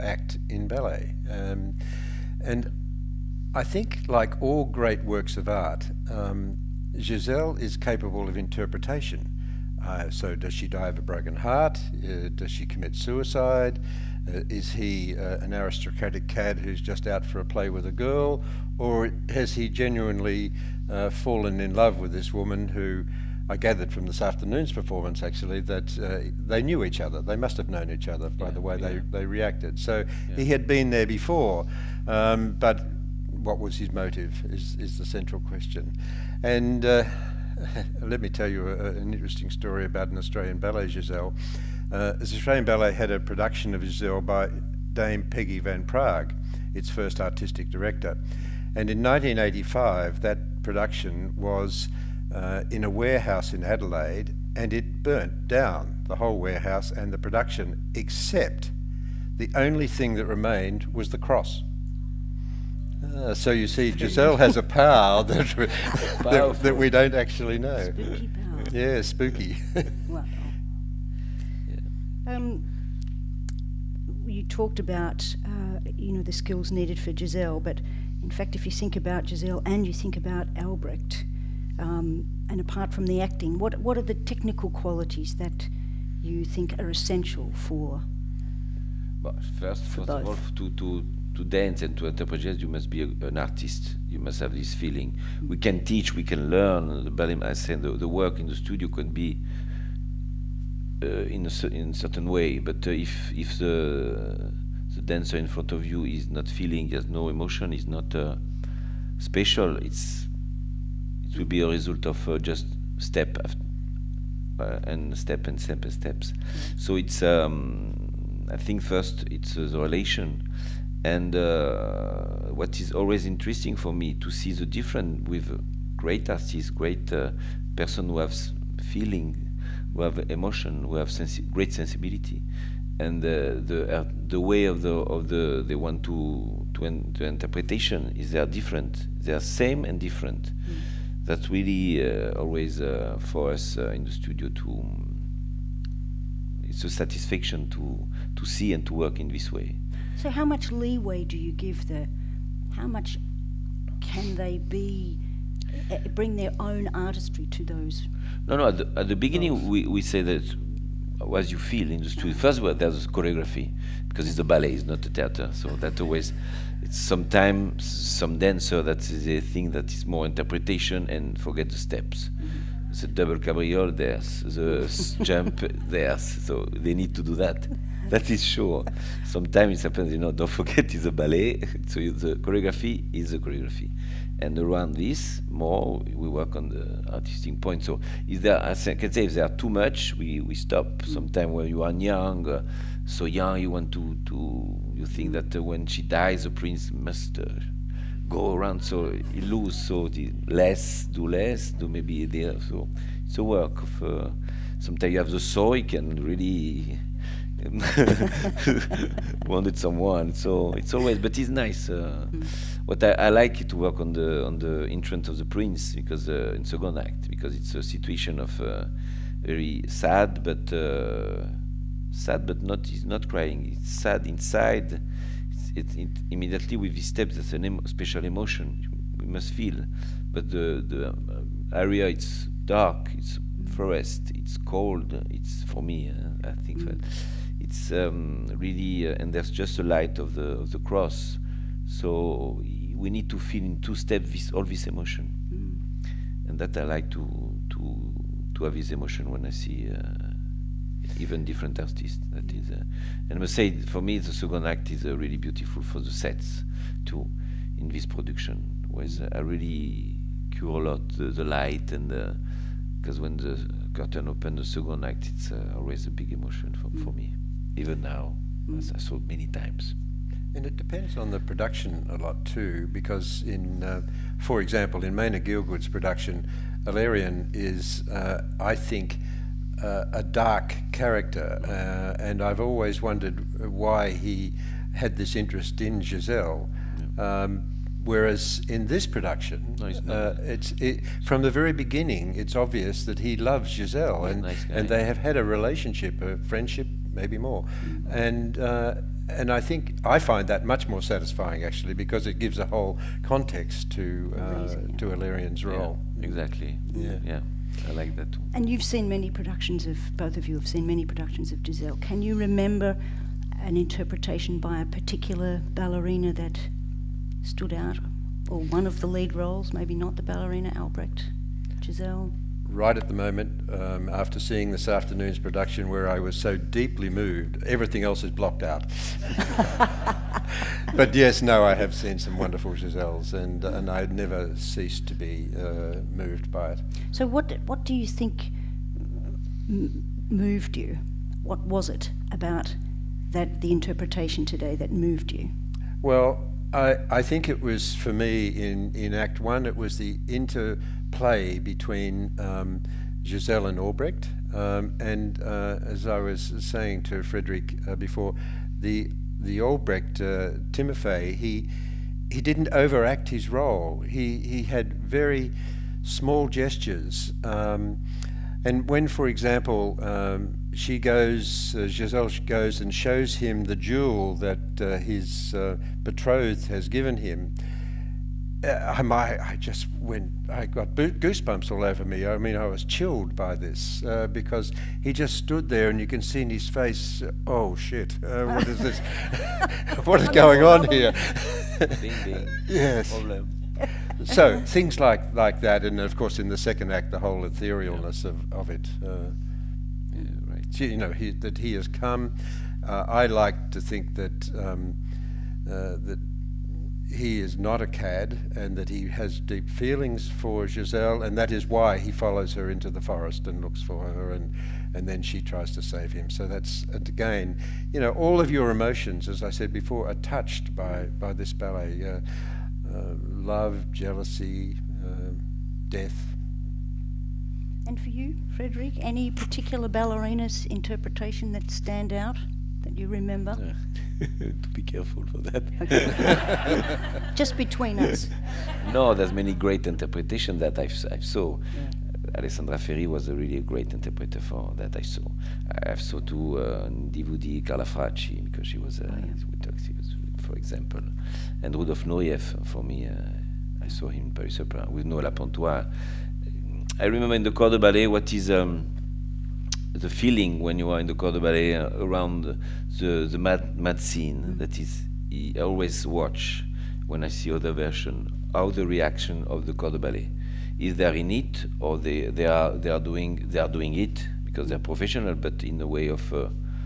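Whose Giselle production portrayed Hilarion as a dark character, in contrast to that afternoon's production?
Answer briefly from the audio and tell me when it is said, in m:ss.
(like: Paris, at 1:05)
Maina Gielgud, at 4:35.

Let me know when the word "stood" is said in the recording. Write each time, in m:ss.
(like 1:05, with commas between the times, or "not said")
5:17, 6:25.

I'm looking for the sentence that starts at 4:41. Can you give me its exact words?
Uh, and I've always wondered why he had this interest in Giselle.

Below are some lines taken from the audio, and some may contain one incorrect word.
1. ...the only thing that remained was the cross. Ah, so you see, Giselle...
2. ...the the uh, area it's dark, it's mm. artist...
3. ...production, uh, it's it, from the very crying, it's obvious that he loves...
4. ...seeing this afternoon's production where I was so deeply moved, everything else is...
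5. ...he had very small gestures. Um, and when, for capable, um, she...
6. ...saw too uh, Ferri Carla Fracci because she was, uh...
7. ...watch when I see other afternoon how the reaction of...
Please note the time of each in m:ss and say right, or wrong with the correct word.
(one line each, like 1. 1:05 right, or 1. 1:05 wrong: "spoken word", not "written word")
1. 0:59 right
2. 3:50 wrong: "forest", not "artist"
3. 4:49 wrong: "beginning", not "crying"
4. 5:24 right
5. 6:04 wrong: "example", not "capable"
6. 7:25 wrong: "Divudi", not "Ferri"
7. 7:46 wrong: "version", not "afternoon".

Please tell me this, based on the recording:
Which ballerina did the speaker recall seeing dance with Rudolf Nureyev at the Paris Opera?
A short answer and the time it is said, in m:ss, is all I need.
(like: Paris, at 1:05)
Noëlla Pontois, at 7:35.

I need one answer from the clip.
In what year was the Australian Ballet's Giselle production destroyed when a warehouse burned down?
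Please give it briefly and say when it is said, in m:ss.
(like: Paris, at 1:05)
1985, at 0:49.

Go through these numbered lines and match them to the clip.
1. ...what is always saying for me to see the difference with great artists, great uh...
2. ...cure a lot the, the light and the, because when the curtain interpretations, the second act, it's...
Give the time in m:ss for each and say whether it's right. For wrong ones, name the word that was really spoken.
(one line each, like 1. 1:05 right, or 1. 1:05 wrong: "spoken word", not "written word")
1. 2:02 wrong: "interesting", not "saying"
2. 4:20 wrong: "opens", not "interpretations".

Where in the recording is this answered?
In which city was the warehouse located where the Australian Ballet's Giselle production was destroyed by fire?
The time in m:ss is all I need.
0:53.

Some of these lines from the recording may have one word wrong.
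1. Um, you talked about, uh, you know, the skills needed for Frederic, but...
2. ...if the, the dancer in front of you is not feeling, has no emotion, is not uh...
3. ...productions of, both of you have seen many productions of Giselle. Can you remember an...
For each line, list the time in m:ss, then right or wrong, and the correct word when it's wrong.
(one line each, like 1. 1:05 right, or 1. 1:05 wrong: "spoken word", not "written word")
1. 1:12 wrong: "Giselle", not "Frederic"
2. 1:43 right
3. 5:09 right.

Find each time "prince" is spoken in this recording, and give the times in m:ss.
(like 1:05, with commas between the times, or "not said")
3:16, 3:35.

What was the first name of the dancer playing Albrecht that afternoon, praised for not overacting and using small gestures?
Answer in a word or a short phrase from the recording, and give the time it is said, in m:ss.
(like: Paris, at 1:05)
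Timofey, at 6:00.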